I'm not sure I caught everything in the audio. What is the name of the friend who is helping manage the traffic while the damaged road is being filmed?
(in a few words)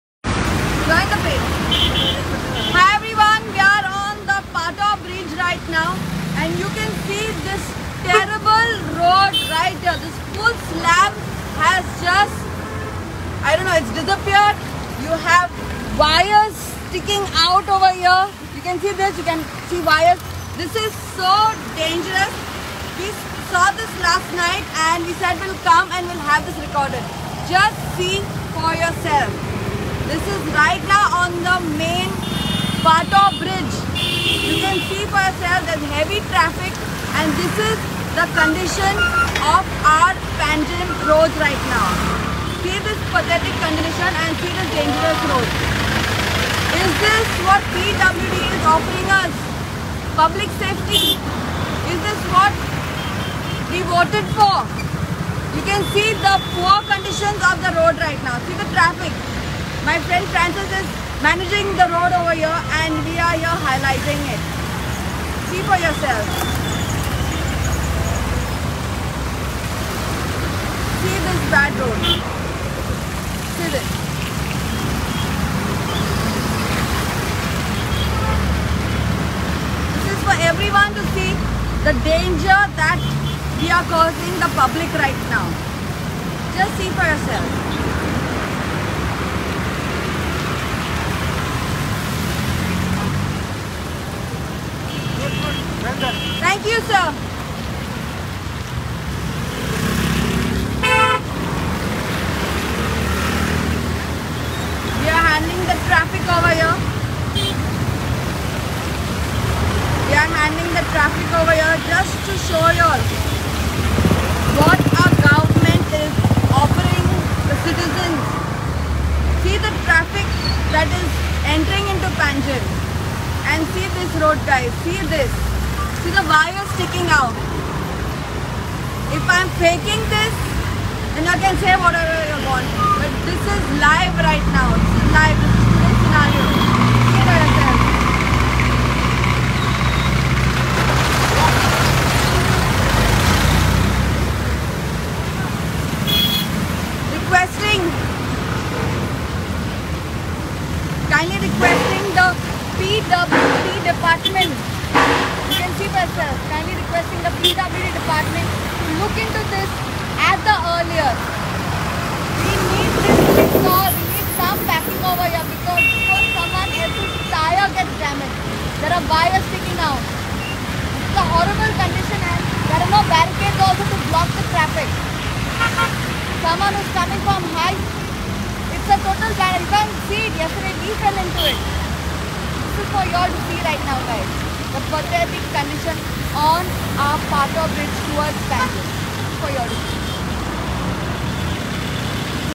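Francis.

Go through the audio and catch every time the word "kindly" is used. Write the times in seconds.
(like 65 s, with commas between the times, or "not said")
151 s, 156 s.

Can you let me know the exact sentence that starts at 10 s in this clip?
This full slab has just, I don't know, it's disappeared.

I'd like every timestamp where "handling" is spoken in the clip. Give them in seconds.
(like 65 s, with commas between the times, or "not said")
105 s, 110 s.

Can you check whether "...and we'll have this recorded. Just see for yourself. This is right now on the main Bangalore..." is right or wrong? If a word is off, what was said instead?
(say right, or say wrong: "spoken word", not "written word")
wrong: "Patto", not "Bangalore".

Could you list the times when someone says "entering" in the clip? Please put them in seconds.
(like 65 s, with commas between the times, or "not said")
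121 s.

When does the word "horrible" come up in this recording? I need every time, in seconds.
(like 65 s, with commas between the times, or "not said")
171 s.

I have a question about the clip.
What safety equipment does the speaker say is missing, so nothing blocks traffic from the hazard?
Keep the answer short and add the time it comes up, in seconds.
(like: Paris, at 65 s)
barricades, at 173 s.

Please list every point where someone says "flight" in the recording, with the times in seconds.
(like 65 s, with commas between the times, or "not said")
not said.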